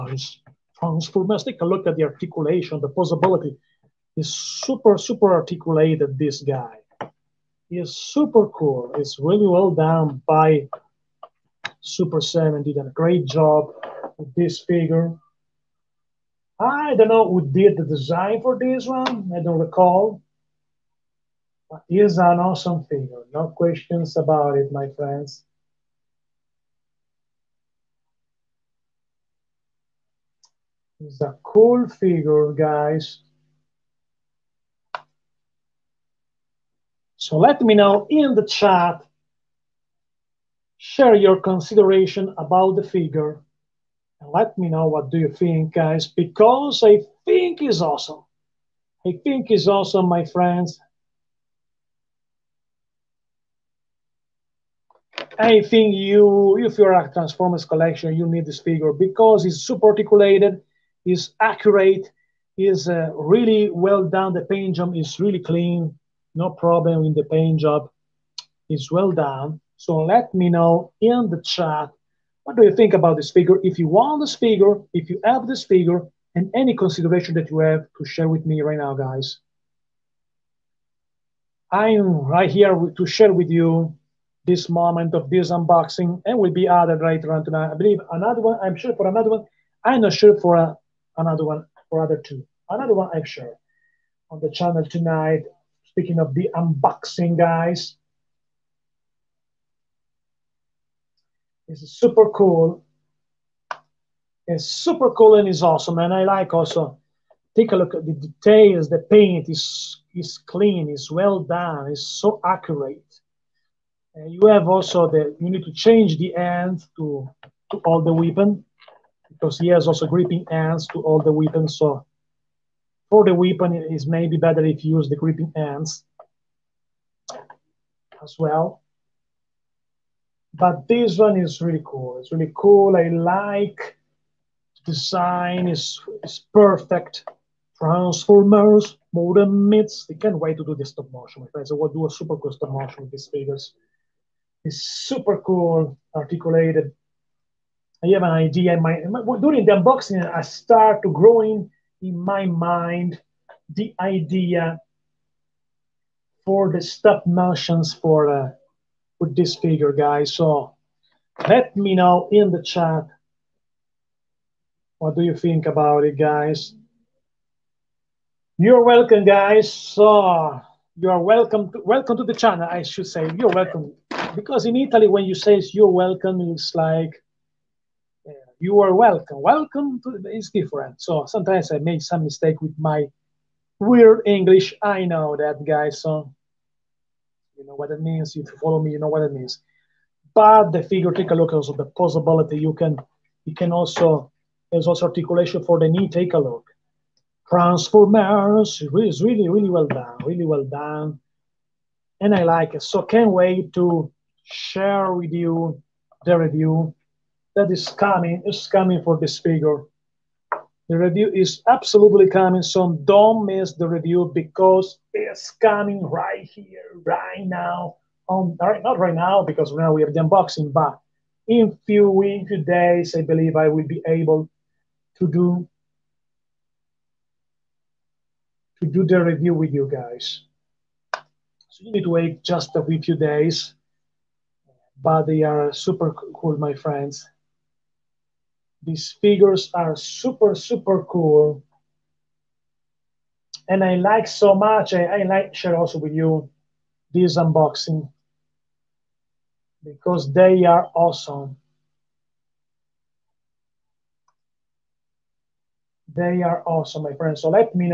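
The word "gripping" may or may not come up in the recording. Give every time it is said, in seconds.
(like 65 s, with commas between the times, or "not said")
120 s, 125 s.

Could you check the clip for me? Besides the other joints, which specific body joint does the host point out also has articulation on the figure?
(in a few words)
Knee.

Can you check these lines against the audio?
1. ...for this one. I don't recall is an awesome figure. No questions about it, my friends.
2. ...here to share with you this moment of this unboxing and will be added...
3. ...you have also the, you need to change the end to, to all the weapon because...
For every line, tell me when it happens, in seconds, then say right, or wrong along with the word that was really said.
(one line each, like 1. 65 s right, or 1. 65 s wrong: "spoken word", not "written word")
1. 18 s right
2. 82 s right
3. 114 s right.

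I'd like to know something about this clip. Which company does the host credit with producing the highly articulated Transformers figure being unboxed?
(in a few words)
Super7.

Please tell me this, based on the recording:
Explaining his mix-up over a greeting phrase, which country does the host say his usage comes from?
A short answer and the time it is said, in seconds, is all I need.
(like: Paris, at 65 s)
Italy, at 174 s.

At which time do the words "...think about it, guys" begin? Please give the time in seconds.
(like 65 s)
165 s.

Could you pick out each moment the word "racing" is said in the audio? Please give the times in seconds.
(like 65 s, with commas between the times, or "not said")
not said.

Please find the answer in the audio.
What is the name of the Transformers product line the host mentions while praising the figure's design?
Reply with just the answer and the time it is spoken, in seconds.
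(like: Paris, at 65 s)
Modern Myths, at 139 s.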